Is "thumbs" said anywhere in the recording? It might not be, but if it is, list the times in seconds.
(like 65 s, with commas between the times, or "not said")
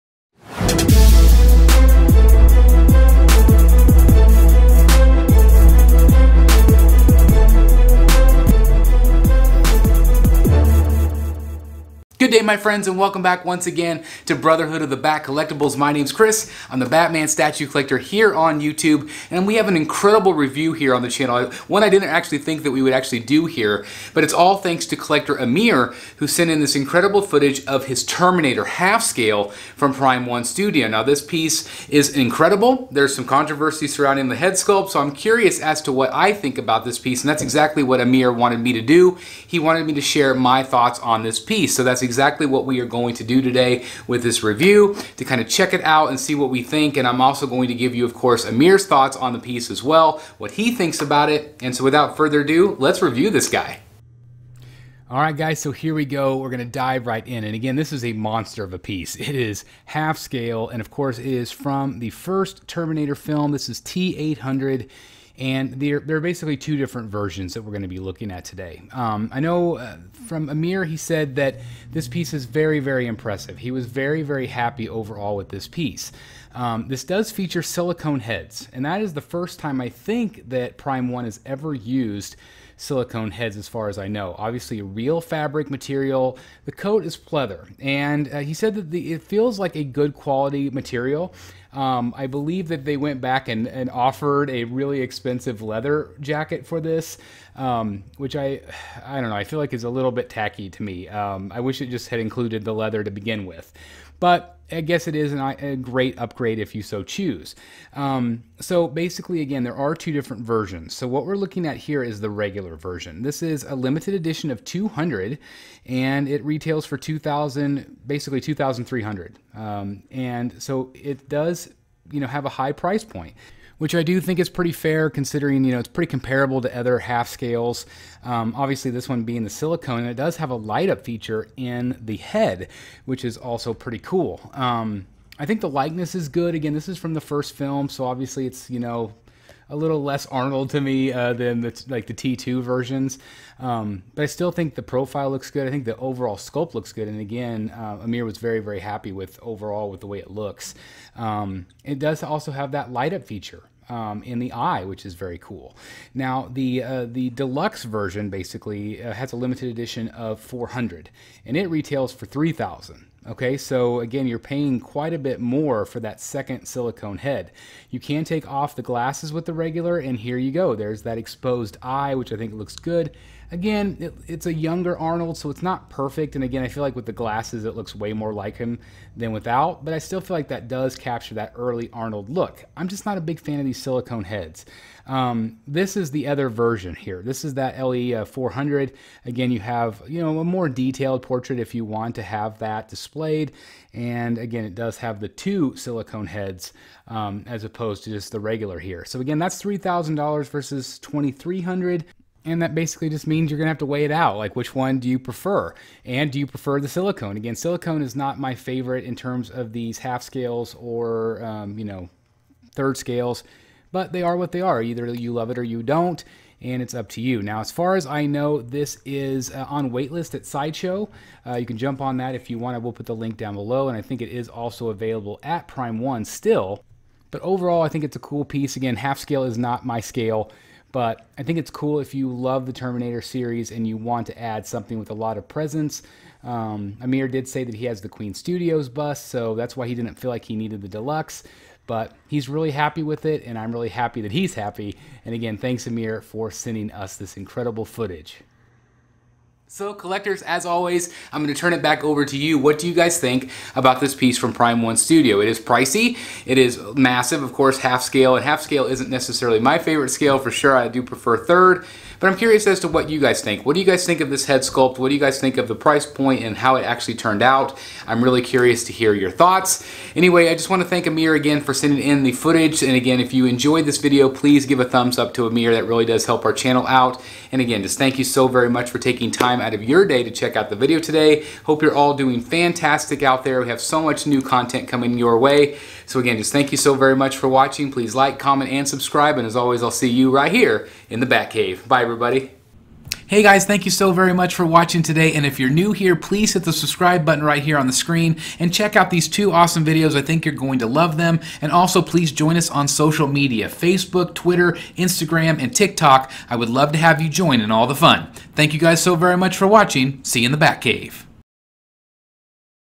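274 s.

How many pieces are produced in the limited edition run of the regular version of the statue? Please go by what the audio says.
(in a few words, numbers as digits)
200.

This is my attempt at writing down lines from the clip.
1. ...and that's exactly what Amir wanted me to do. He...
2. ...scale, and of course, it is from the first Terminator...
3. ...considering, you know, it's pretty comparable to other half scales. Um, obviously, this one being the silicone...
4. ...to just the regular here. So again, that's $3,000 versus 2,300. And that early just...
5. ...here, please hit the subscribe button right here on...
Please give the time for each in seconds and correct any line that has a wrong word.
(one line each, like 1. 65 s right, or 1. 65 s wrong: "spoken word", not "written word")
1. 37 s right
2. 60 s right
3. 125 s right
4. 198 s wrong: "basically", not "early"
5. 295 s right.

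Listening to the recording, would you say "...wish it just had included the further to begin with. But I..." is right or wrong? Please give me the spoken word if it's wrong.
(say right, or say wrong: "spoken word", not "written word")
wrong: "leather", not "further".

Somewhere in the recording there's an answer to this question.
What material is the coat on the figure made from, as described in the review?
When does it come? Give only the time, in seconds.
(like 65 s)
87 s.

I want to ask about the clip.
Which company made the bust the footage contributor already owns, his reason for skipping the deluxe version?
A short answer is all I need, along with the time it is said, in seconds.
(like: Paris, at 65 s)
Queen Studios, at 238 s.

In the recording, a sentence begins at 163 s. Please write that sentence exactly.
Okay, so again, you're paying quite a bit more for that second silicone head.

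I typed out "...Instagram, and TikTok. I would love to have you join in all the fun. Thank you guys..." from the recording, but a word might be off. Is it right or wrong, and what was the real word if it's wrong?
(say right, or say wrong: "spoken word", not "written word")
right.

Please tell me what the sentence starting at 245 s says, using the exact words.
And again, thanks, Amir, for sending us this incredible footage.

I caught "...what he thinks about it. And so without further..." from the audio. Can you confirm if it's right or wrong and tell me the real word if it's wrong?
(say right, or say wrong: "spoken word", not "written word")
right.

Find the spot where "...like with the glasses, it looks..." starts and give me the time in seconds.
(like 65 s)
176 s.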